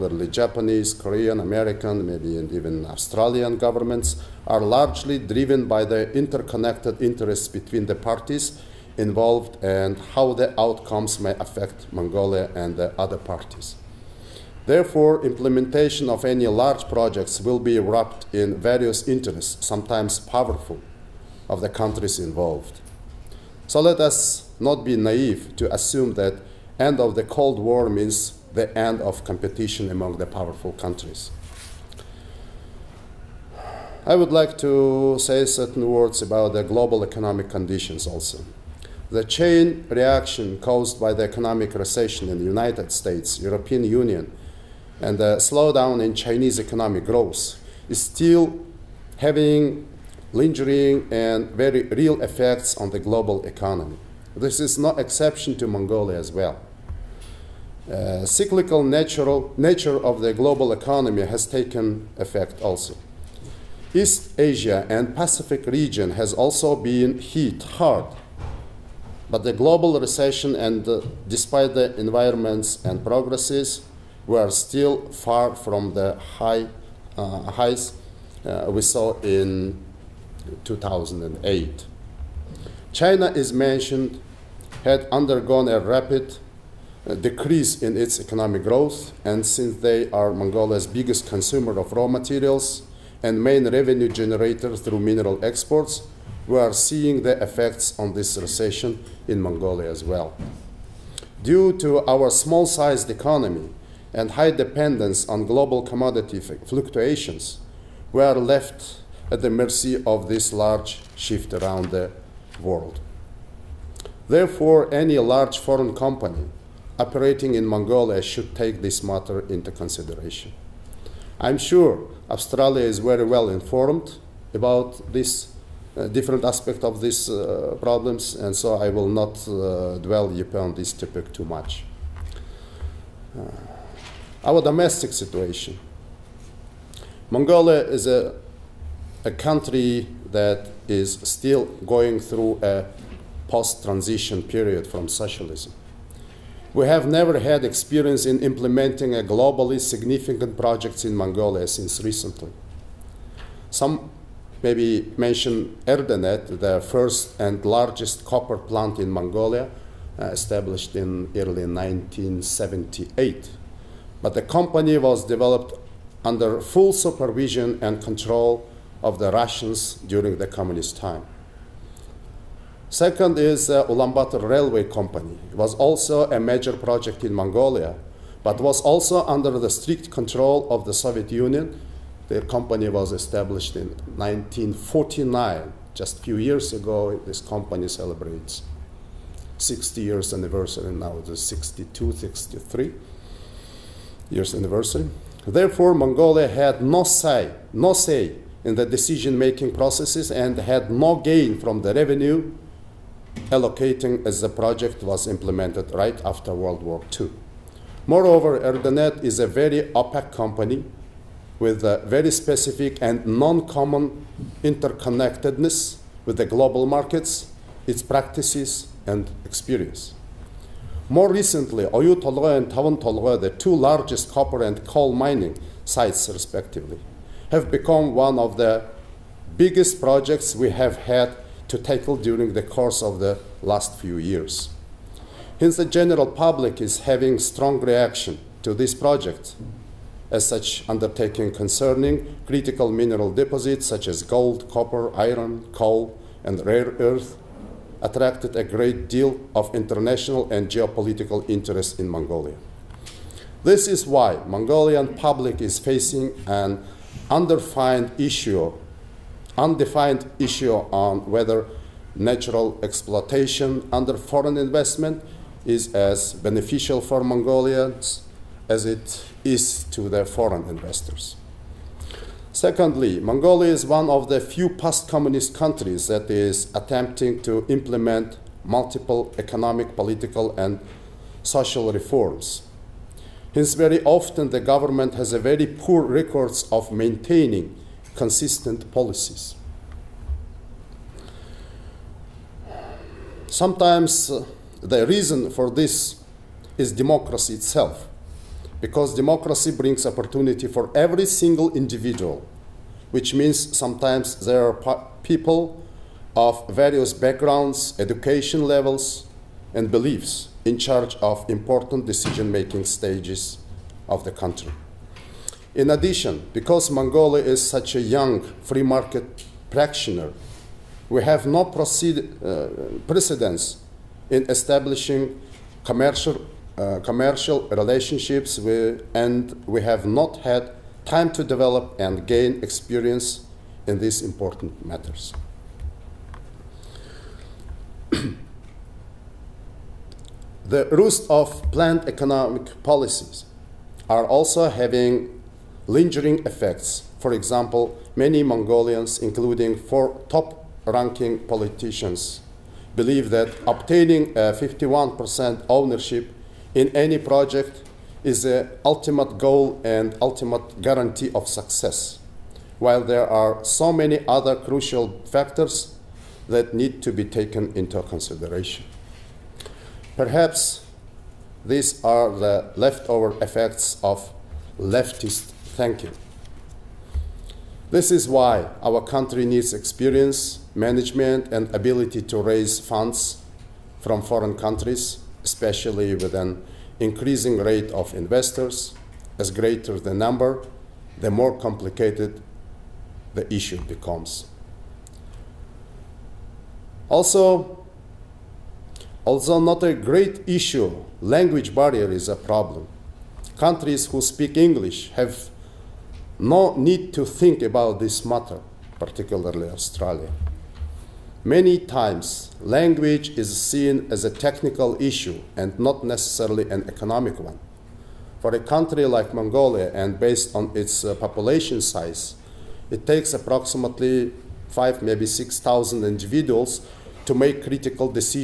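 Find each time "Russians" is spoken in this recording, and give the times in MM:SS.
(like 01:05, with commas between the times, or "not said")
02:49.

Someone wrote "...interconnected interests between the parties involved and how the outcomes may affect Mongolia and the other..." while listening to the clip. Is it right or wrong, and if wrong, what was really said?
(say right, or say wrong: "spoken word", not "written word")
right.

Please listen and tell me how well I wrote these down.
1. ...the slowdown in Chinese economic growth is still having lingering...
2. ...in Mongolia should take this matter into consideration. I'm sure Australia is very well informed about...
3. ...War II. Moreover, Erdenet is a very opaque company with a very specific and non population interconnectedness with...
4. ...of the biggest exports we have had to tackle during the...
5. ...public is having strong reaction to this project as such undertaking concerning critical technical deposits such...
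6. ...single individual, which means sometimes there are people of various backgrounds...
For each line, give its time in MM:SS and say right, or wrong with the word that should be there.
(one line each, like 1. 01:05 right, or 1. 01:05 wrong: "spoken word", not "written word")
1. 00:45 right
2. 01:57 right
3. 03:26 wrong: "common", not "population"
4. 03:48 wrong: "projects", not "exports"
5. 03:56 wrong: "mineral", not "technical"
6. 05:01 right.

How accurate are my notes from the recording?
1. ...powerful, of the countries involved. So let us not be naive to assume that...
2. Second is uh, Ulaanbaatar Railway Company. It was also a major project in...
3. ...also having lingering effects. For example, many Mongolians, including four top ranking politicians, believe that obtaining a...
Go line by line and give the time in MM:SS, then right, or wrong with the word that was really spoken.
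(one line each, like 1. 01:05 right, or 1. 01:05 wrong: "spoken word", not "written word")
1. 00:20 right
2. 02:52 right
3. 05:44 right.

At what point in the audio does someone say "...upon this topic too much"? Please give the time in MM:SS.
02:10.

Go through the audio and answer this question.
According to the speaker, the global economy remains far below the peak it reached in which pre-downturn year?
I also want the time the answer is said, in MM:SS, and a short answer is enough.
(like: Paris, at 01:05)
2008, at 01:20.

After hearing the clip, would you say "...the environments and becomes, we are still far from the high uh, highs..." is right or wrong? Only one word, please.
wrong.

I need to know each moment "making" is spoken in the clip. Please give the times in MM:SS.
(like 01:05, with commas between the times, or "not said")
03:19, 05:12.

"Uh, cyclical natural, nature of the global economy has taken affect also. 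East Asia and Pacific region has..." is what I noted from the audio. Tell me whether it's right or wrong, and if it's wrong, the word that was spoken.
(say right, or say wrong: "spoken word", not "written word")
wrong: "effect", not "affect".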